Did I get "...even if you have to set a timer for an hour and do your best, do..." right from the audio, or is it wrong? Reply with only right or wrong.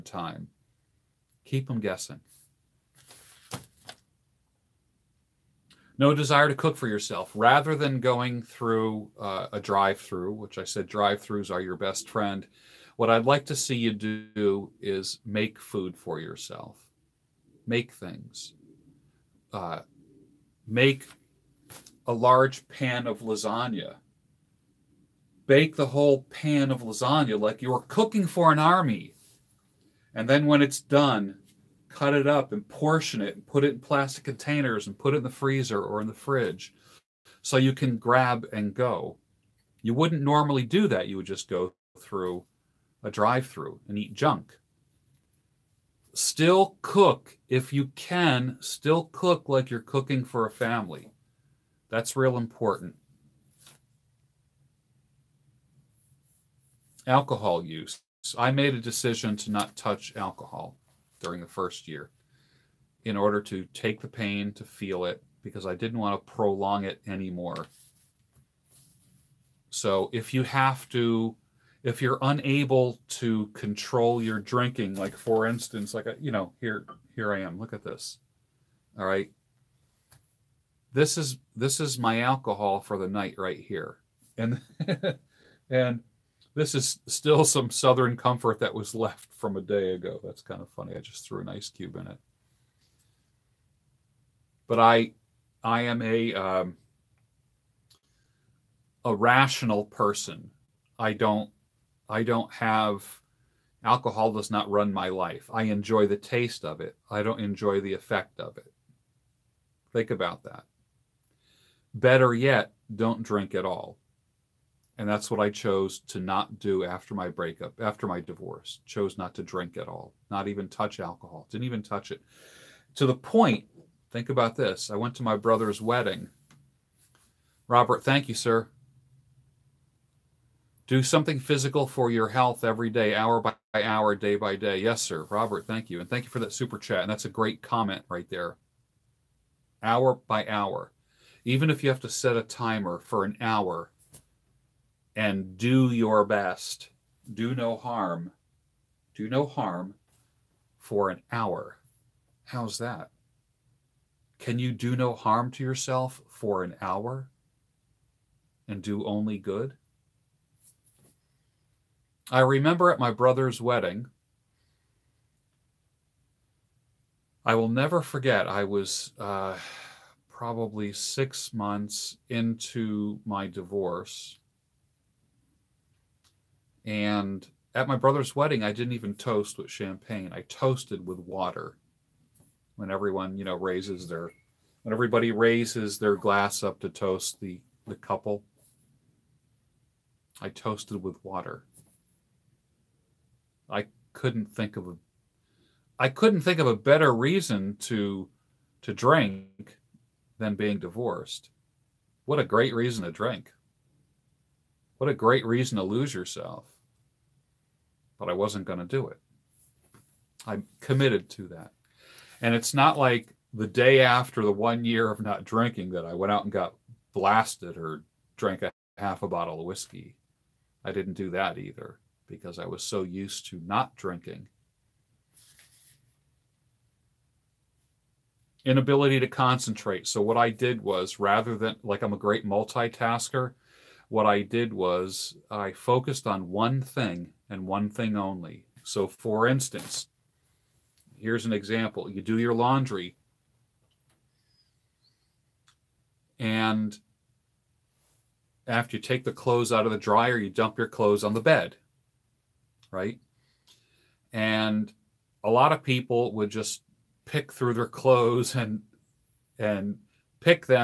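right.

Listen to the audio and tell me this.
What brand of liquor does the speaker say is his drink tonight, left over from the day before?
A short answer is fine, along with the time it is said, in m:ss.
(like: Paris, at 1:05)
Southern Comfort, at 1:27.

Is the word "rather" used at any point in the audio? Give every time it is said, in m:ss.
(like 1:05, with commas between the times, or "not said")
0:07, 3:51.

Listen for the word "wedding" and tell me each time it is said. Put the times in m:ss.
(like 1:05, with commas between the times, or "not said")
2:05, 2:43, 2:58.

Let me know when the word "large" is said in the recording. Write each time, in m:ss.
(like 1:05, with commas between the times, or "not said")
0:22.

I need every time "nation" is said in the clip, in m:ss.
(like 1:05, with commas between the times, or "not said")
not said.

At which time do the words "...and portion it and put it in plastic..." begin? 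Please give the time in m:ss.
0:32.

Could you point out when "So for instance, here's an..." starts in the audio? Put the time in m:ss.
3:58.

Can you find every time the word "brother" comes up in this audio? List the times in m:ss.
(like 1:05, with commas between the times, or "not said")
2:05, 2:43, 2:57.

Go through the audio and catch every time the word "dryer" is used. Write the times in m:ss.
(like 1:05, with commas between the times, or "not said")
4:09.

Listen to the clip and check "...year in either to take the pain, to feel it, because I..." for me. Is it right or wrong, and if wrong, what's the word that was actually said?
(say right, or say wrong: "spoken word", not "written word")
wrong: "order", not "either".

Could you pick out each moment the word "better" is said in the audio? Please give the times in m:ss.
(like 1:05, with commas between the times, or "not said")
1:51, 3:16.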